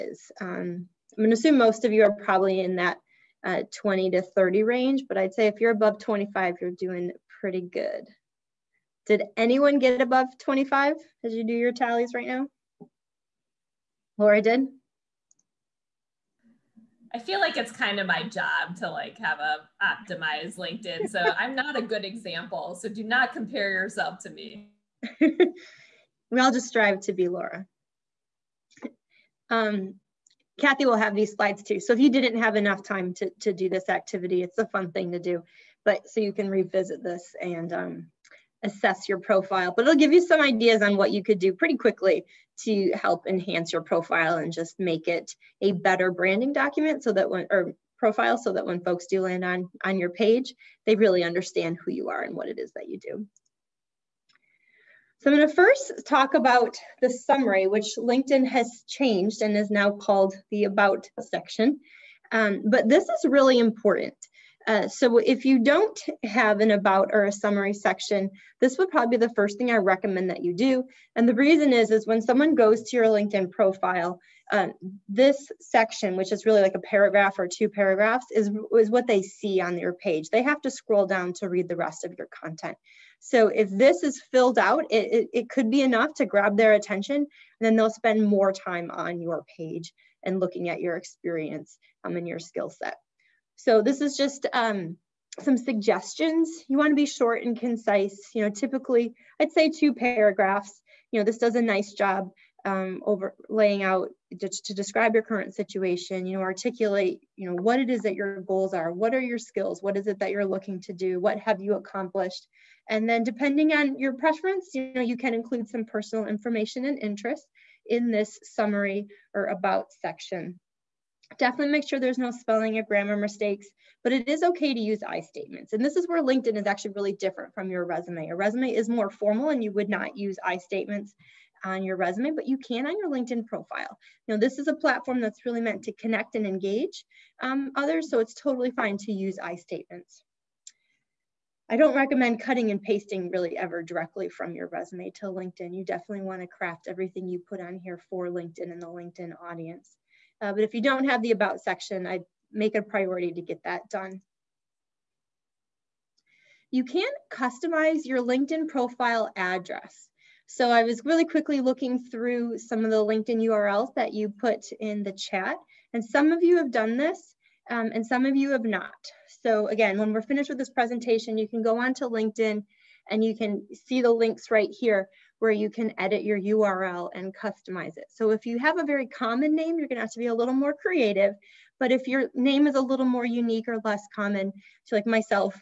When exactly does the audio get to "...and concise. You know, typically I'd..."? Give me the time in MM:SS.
01:37.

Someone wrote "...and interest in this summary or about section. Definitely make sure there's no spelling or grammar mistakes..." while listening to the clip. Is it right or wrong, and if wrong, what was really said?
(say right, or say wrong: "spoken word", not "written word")
right.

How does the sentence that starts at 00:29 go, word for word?
Um, Kathy will have these slides too.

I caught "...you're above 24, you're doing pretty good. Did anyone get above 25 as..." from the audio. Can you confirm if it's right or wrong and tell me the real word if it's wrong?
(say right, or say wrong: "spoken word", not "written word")
wrong: "25", not "24".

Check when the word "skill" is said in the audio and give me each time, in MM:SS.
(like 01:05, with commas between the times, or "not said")
01:32, 01:49.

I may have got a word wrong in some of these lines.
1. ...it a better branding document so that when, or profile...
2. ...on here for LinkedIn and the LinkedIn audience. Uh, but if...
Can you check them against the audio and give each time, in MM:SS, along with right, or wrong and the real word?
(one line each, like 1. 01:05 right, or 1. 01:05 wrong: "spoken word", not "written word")
1. 00:45 right
2. 02:27 right.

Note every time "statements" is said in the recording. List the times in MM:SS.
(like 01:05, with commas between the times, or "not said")
02:05, 02:10, 02:19.